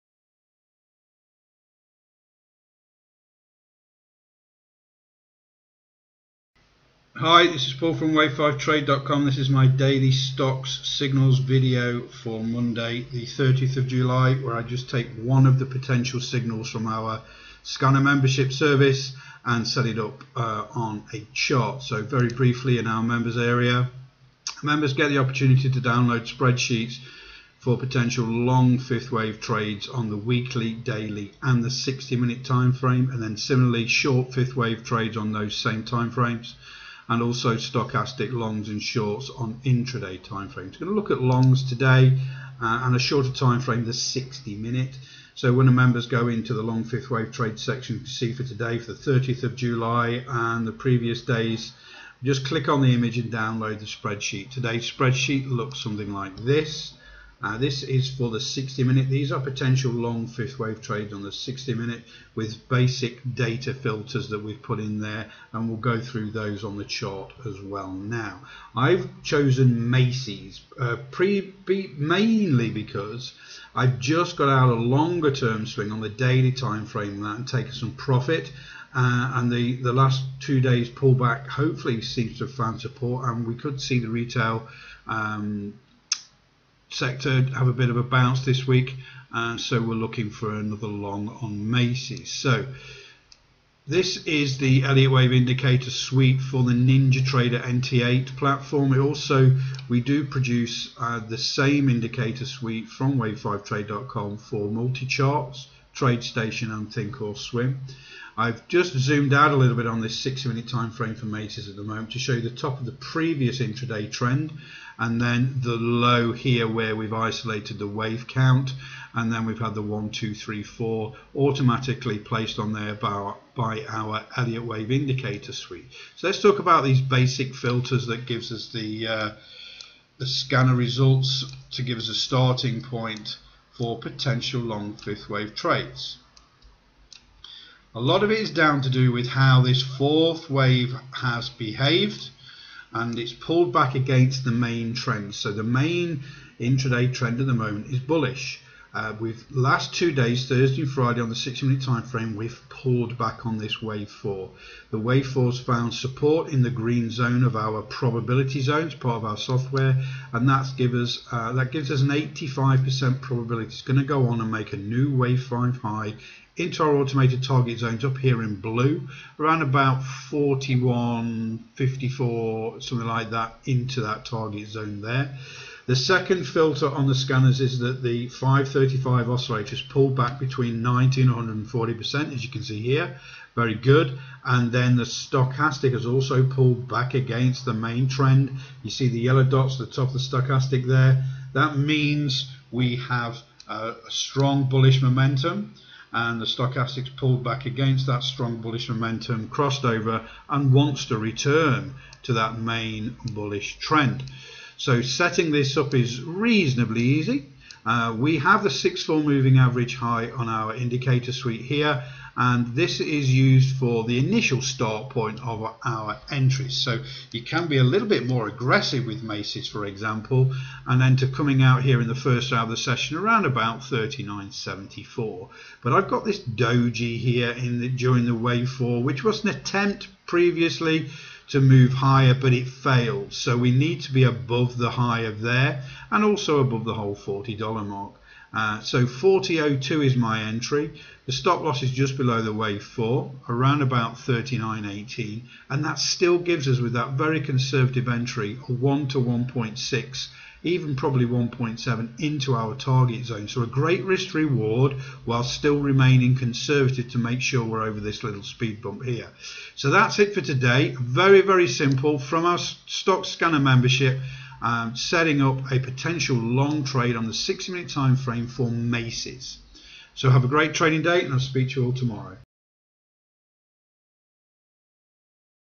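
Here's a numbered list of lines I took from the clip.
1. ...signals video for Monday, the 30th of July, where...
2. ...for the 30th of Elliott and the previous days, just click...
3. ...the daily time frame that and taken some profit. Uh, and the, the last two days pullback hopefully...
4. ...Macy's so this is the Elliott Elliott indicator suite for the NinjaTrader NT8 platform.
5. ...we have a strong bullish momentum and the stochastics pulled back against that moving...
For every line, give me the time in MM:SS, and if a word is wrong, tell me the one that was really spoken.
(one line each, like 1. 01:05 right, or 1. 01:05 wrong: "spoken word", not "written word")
1. 00:10 right
2. 00:48 wrong: "July", not "Elliott"
3. 01:16 right
4. 01:31 wrong: "Wave", not "Elliott"
5. 03:12 wrong: "strong", not "moving".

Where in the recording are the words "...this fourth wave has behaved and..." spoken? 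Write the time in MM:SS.
02:19.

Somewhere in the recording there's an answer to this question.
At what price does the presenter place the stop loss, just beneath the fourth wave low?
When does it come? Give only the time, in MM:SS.
04:04.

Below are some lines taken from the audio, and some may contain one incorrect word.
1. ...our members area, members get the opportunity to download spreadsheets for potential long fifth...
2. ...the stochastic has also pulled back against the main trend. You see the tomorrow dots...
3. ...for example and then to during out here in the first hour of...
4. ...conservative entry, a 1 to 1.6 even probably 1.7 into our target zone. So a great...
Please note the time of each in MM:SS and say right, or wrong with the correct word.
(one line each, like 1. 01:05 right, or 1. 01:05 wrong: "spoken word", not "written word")
1. 00:22 right
2. 03:04 wrong: "yellow", not "tomorrow"
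3. 03:39 wrong: "coming", not "during"
4. 04:07 right.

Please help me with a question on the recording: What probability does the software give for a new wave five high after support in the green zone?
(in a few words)
85%.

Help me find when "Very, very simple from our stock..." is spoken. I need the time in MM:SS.
04:21.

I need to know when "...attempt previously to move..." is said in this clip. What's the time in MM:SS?
03:49.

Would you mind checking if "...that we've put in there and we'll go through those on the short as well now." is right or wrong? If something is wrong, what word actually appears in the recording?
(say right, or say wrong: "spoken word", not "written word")
wrong: "chart", not "short".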